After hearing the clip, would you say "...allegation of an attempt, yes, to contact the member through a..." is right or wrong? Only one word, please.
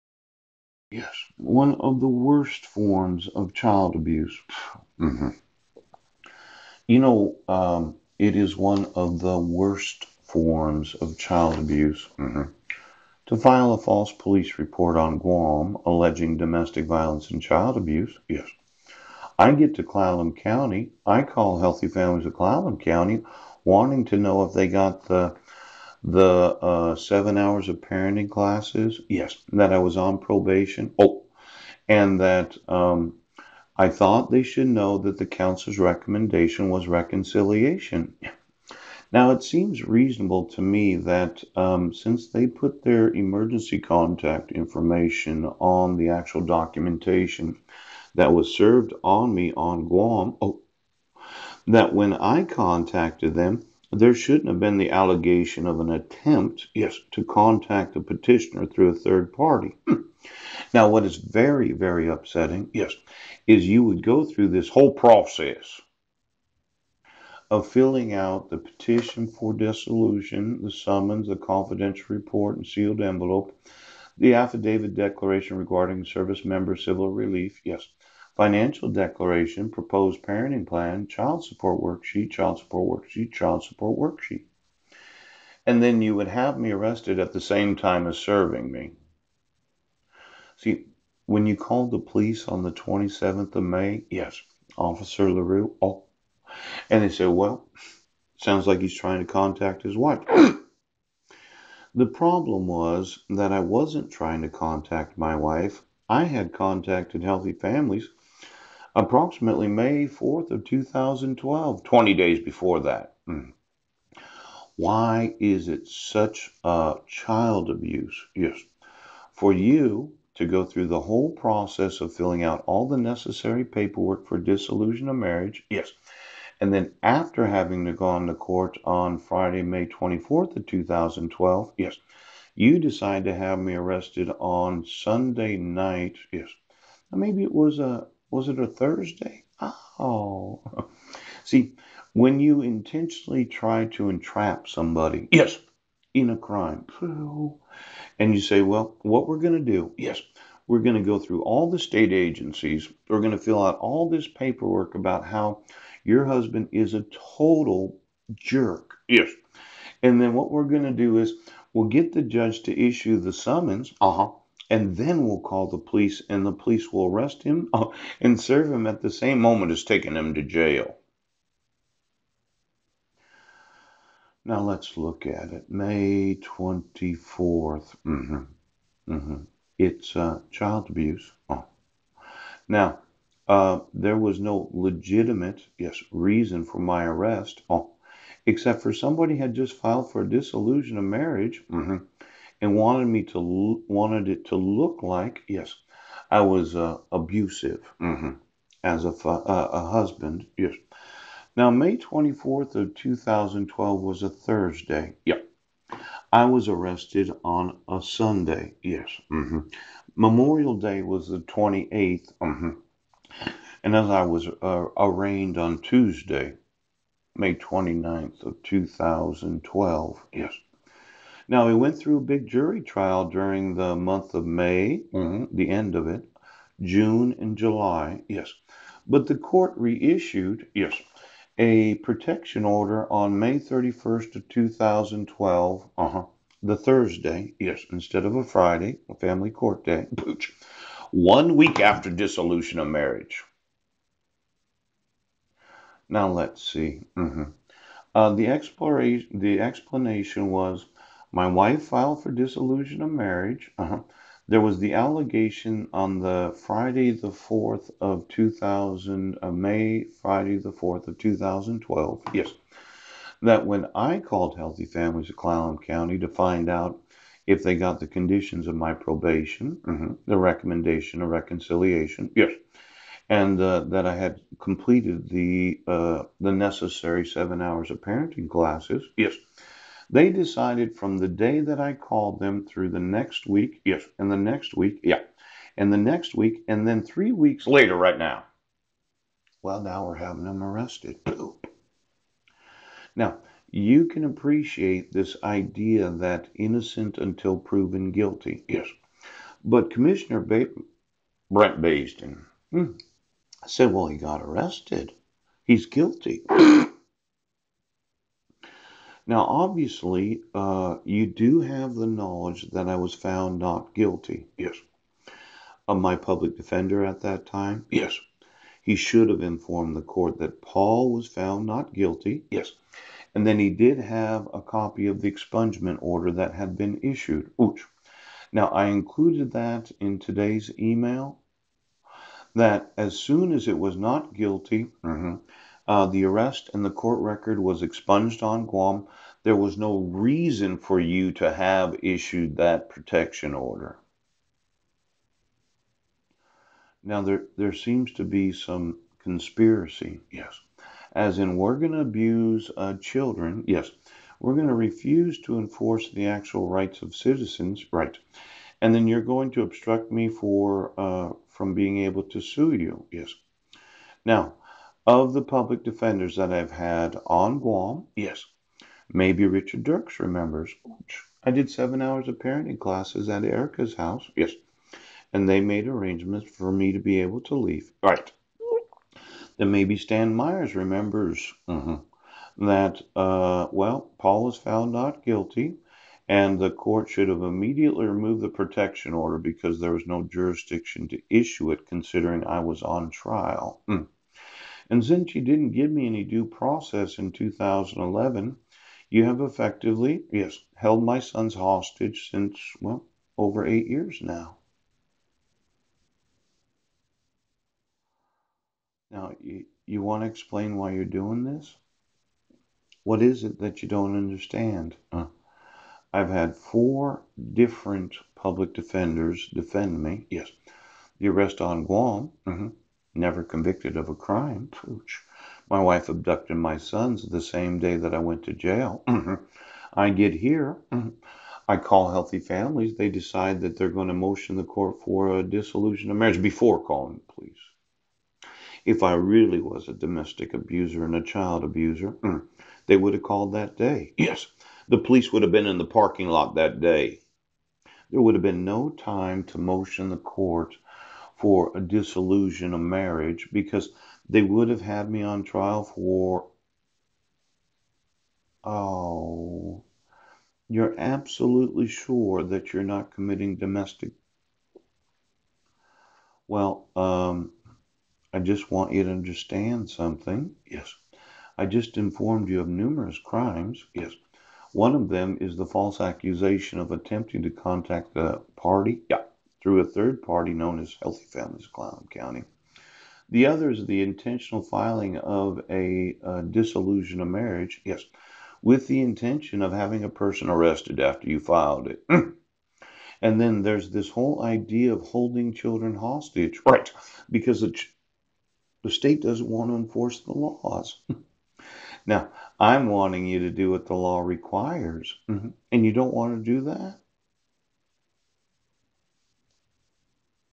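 wrong.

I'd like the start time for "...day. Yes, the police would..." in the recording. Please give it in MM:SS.
07:23.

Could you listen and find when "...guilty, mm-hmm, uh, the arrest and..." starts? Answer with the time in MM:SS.
05:34.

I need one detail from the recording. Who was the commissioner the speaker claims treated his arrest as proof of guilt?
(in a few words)
Brent Basden.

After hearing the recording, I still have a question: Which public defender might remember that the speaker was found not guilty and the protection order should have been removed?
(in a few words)
Stan Myers.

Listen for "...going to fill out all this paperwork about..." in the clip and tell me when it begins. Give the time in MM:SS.
02:33.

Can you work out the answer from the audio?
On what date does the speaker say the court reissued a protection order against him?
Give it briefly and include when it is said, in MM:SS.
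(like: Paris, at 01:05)
May 31st, 2012, at 03:53.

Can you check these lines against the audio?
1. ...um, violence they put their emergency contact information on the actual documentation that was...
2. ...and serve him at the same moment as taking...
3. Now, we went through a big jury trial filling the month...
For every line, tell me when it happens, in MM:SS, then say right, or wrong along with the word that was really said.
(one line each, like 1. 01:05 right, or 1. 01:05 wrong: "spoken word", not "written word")
1. 00:41 wrong: "since", not "violence"
2. 02:48 right
3. 03:41 wrong: "during", not "filling".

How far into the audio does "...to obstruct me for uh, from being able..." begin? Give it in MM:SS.
05:59.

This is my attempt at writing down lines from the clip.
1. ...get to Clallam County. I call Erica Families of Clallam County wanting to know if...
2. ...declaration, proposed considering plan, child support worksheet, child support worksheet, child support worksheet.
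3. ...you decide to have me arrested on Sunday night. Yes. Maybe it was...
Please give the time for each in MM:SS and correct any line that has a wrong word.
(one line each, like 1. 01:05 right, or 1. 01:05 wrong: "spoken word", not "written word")
1. 00:19 wrong: "Healthy", not "Erica"
2. 01:18 wrong: "parenting", not "considering"
3. 02:12 right.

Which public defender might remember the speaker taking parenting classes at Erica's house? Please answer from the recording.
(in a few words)
Richard Dirks.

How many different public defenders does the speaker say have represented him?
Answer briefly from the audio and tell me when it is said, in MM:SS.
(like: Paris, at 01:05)
4, at 06:56.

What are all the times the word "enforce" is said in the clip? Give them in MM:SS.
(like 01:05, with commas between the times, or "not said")
05:55, 08:19.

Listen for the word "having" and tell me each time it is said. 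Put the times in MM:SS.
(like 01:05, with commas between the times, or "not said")
02:07, 04:50, 08:09.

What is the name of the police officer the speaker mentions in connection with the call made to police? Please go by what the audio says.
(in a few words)
Officer LaRue.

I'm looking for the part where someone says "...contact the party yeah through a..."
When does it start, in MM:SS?
07:57.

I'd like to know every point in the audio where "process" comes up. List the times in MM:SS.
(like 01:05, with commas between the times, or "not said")
01:04, 02:01, 06:36.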